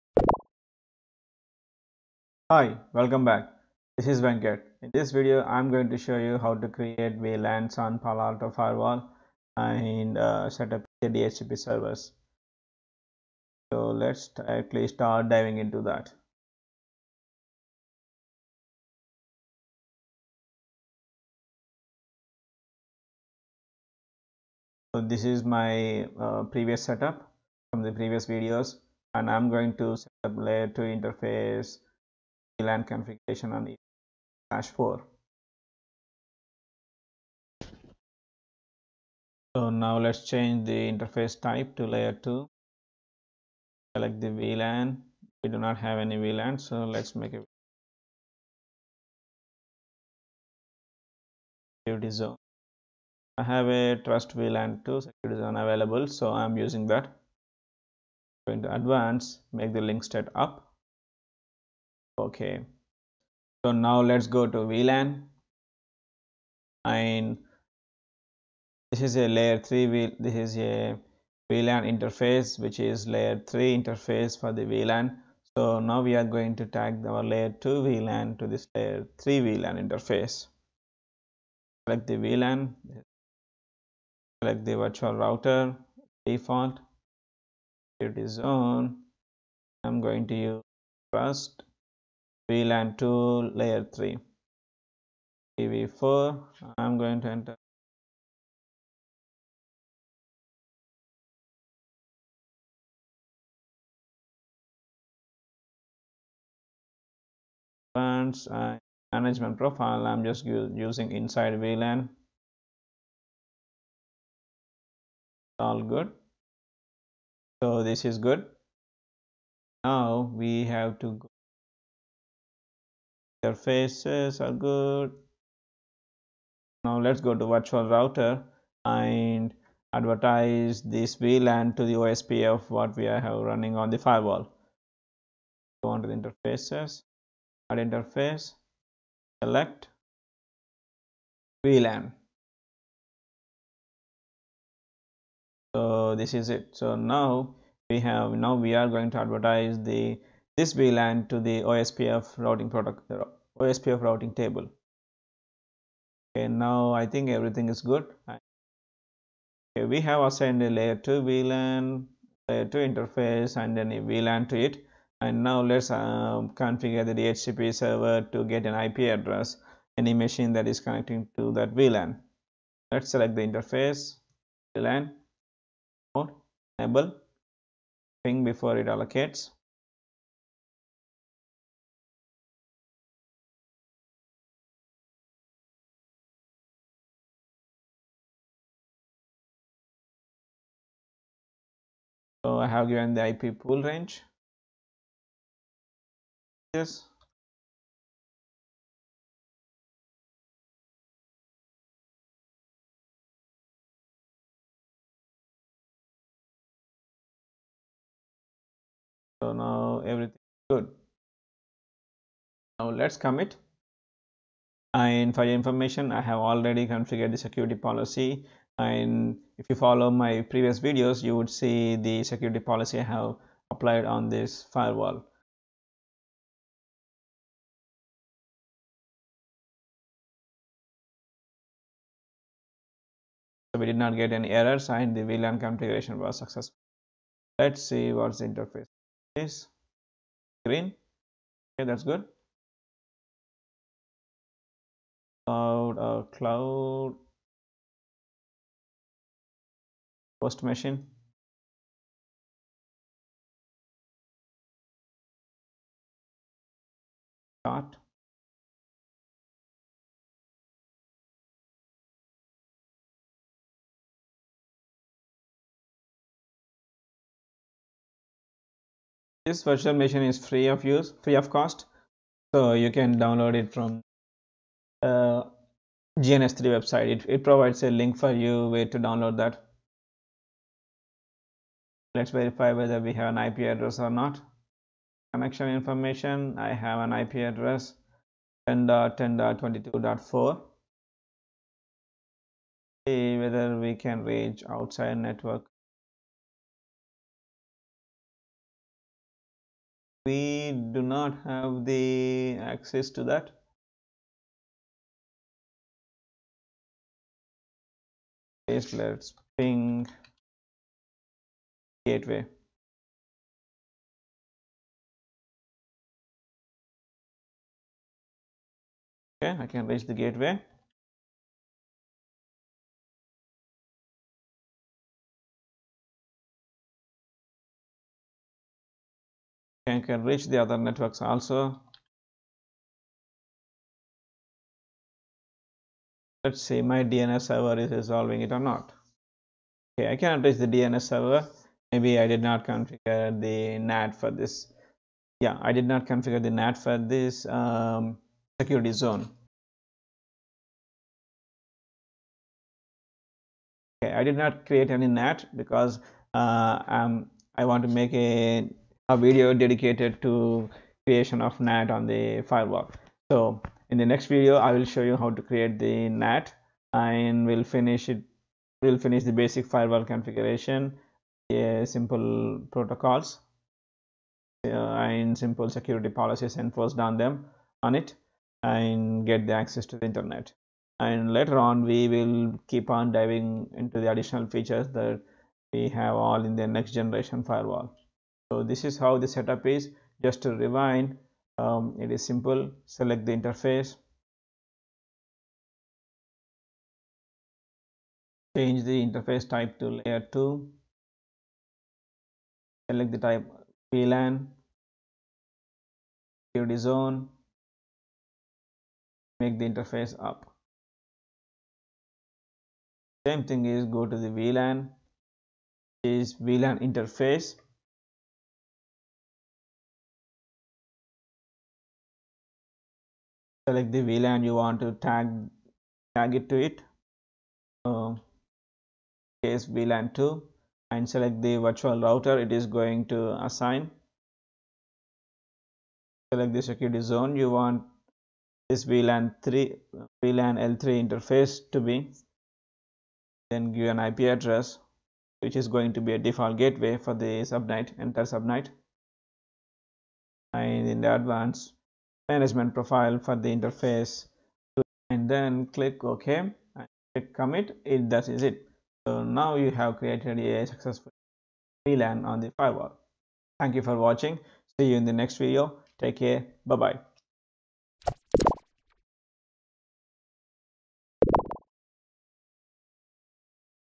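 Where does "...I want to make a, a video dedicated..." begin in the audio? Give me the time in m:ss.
5:57.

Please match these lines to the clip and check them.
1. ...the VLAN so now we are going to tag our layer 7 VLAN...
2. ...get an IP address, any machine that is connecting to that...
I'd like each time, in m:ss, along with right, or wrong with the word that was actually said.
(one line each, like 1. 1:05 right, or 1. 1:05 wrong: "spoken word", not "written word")
1. 1:14 wrong: "2", not "7"
2. 2:48 right.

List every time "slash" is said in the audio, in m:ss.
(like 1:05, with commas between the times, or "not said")
0:34.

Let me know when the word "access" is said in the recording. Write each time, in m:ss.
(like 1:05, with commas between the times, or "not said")
5:02, 6:19.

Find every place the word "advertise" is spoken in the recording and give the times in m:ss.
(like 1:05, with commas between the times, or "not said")
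2:09, 2:29.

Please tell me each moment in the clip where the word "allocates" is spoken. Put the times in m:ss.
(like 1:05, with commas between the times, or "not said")
2:58.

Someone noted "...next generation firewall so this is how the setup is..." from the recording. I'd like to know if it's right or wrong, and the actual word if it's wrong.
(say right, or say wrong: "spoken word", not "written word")
right.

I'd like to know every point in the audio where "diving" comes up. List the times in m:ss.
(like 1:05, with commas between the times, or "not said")
0:15, 6:23.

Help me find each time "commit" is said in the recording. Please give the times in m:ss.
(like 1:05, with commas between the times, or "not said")
3:33, 7:37.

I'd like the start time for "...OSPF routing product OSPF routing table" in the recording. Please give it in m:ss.
2:31.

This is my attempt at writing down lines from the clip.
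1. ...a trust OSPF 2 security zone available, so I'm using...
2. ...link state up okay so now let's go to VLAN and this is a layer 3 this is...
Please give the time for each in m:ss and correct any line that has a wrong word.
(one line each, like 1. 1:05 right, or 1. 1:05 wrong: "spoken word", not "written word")
1. 0:53 wrong: "VLAN", not "OSPF"
2. 0:59 right.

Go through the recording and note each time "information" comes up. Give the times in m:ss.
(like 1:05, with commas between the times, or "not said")
3:35, 4:45.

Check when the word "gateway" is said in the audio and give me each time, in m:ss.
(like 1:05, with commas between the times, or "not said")
5:12, 5:20, 7:26.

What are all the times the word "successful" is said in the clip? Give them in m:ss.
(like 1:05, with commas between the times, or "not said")
3:56, 7:40.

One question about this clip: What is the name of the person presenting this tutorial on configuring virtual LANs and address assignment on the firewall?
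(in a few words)
Venkat.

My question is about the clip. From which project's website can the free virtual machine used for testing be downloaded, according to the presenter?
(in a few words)
GNS3.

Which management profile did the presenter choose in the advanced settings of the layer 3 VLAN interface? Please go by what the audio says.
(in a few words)
inside VLAN.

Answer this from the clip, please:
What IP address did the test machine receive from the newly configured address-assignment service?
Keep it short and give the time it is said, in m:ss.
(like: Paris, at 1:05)
10.10.22.4, at 4:48.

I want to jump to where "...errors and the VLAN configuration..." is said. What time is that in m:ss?
3:54.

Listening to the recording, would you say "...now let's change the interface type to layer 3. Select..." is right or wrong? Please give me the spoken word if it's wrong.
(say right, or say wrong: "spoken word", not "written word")
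wrong: "2", not "3".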